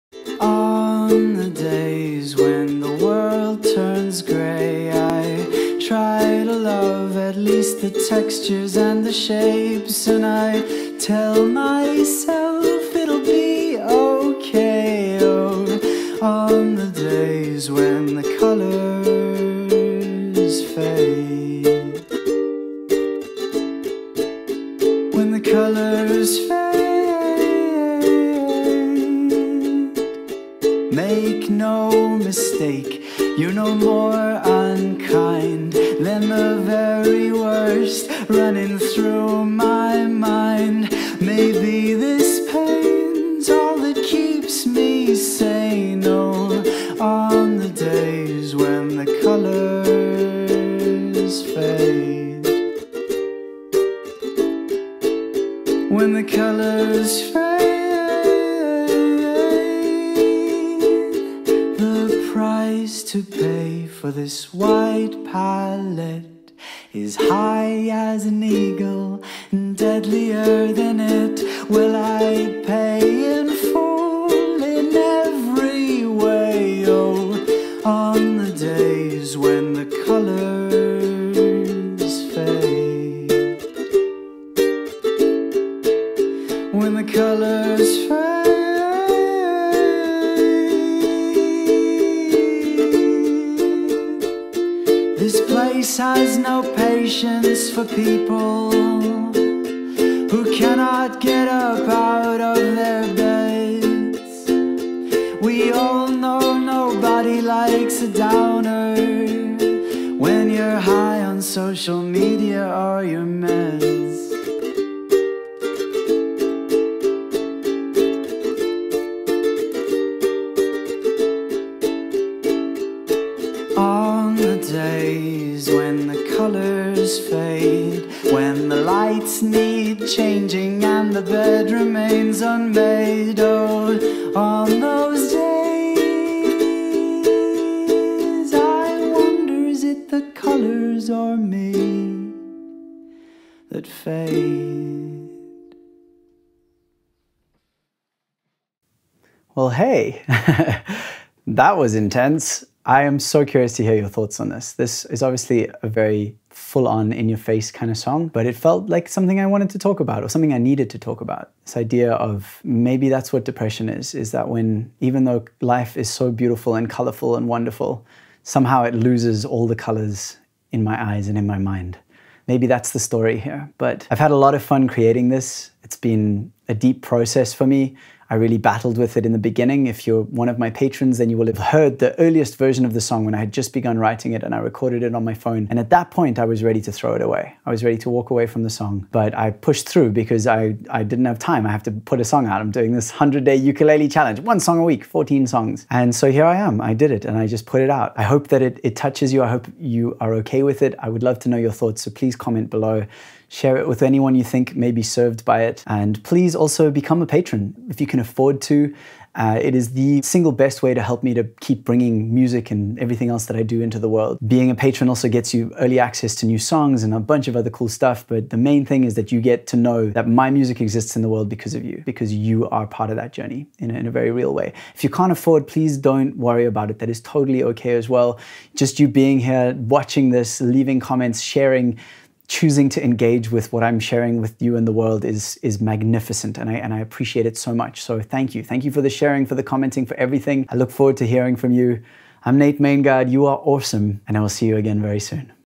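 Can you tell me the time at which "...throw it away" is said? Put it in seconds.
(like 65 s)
186 s.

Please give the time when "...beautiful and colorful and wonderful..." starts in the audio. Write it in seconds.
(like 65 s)
166 s.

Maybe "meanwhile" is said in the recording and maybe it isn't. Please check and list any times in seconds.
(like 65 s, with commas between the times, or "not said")
not said.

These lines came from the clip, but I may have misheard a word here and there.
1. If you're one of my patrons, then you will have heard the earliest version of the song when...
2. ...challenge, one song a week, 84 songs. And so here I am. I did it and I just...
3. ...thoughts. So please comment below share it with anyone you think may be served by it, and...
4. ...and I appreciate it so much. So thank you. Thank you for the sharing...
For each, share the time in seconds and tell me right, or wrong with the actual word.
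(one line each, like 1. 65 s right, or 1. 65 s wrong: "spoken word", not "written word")
1. 179 s right
2. 194 s wrong: "14", not "84"
3. 201 s right
4. 236 s right.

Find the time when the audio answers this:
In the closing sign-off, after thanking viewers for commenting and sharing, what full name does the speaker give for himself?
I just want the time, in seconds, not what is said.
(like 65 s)
242 s.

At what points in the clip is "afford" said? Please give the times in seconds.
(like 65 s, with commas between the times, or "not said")
208 s, 225 s.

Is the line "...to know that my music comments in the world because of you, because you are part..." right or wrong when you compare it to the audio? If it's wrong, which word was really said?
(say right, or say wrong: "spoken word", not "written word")
wrong: "exists", not "comments".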